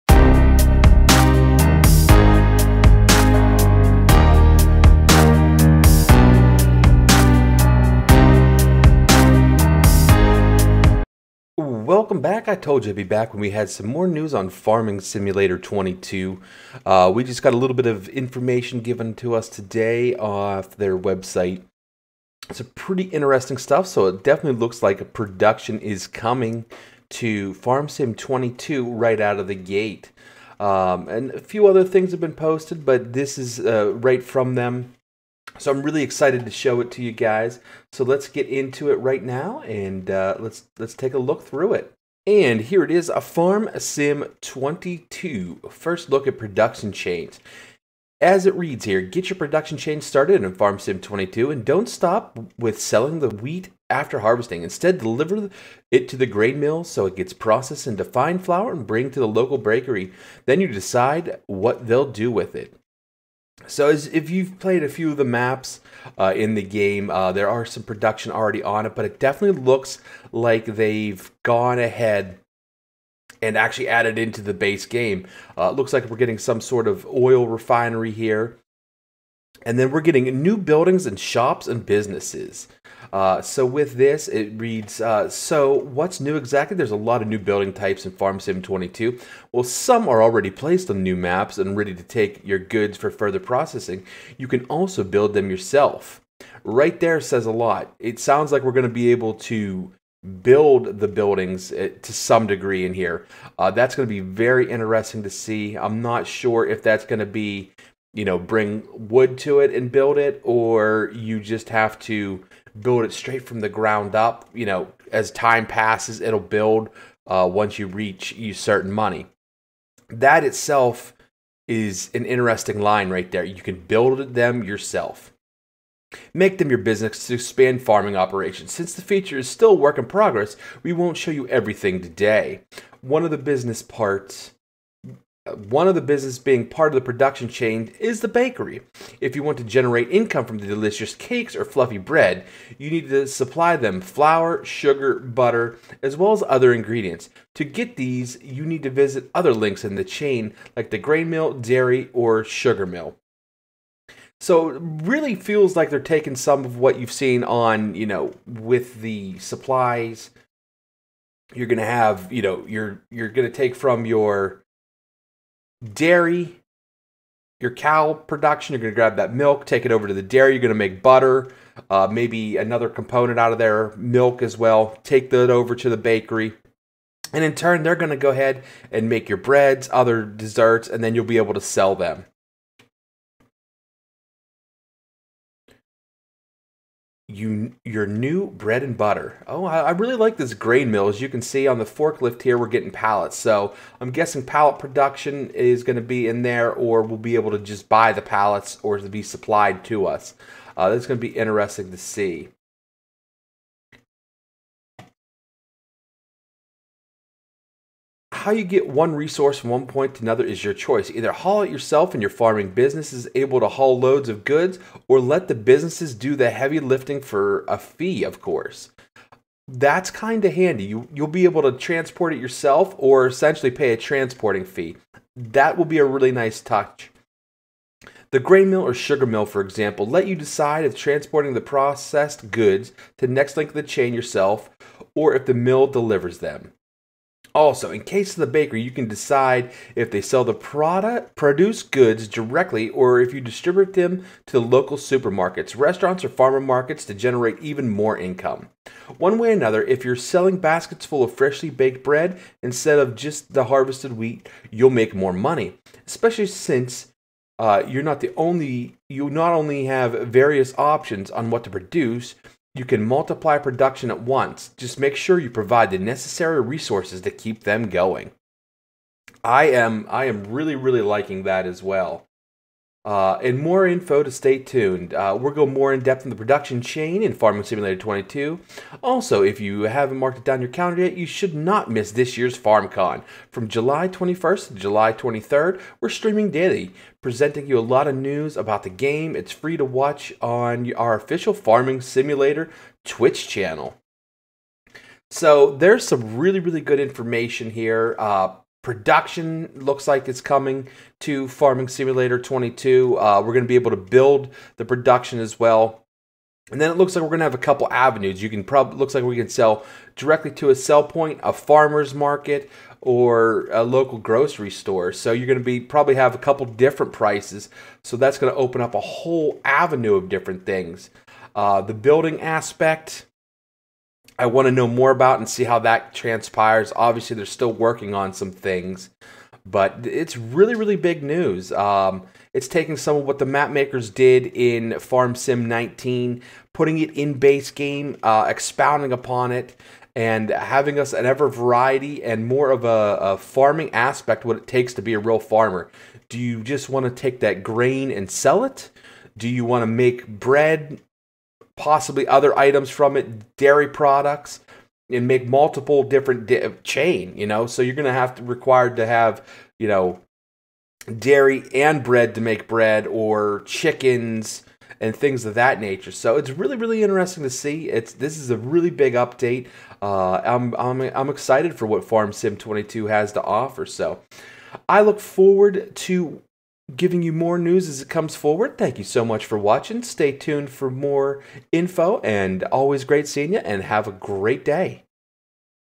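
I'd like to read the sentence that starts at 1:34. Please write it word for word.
You can also build them yourself.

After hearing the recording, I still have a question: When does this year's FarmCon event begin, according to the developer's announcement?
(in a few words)
July 21st.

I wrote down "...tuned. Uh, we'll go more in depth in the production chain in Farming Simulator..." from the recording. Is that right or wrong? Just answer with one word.
right.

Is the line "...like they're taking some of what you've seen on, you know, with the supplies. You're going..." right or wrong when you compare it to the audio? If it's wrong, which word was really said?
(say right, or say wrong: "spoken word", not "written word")
right.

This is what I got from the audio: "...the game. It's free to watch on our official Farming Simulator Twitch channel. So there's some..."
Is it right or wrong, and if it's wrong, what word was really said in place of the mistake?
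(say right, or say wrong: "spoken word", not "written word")
right.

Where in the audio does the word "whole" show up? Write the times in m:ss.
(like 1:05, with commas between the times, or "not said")
5:19.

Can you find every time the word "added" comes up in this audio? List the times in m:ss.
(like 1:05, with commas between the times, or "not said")
1:13.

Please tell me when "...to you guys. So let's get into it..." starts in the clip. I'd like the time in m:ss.
0:36.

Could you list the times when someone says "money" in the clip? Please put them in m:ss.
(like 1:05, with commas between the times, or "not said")
1:58, 4:15.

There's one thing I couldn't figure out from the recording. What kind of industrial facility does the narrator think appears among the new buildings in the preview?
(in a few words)
oil refinery.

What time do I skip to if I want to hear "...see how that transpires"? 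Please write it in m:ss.
5:25.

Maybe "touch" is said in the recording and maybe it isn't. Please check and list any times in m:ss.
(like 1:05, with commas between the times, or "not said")
3:46.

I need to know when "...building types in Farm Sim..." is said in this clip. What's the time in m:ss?
1:27.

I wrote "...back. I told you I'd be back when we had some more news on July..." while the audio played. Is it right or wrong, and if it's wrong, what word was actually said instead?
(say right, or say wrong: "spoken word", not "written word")
wrong: "Farming", not "July".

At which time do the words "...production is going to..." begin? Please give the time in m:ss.
3:14.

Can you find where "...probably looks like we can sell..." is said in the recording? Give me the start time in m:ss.
5:08.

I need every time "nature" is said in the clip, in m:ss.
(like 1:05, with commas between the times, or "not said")
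6:05.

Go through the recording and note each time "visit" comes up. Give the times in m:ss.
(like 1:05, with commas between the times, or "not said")
2:28.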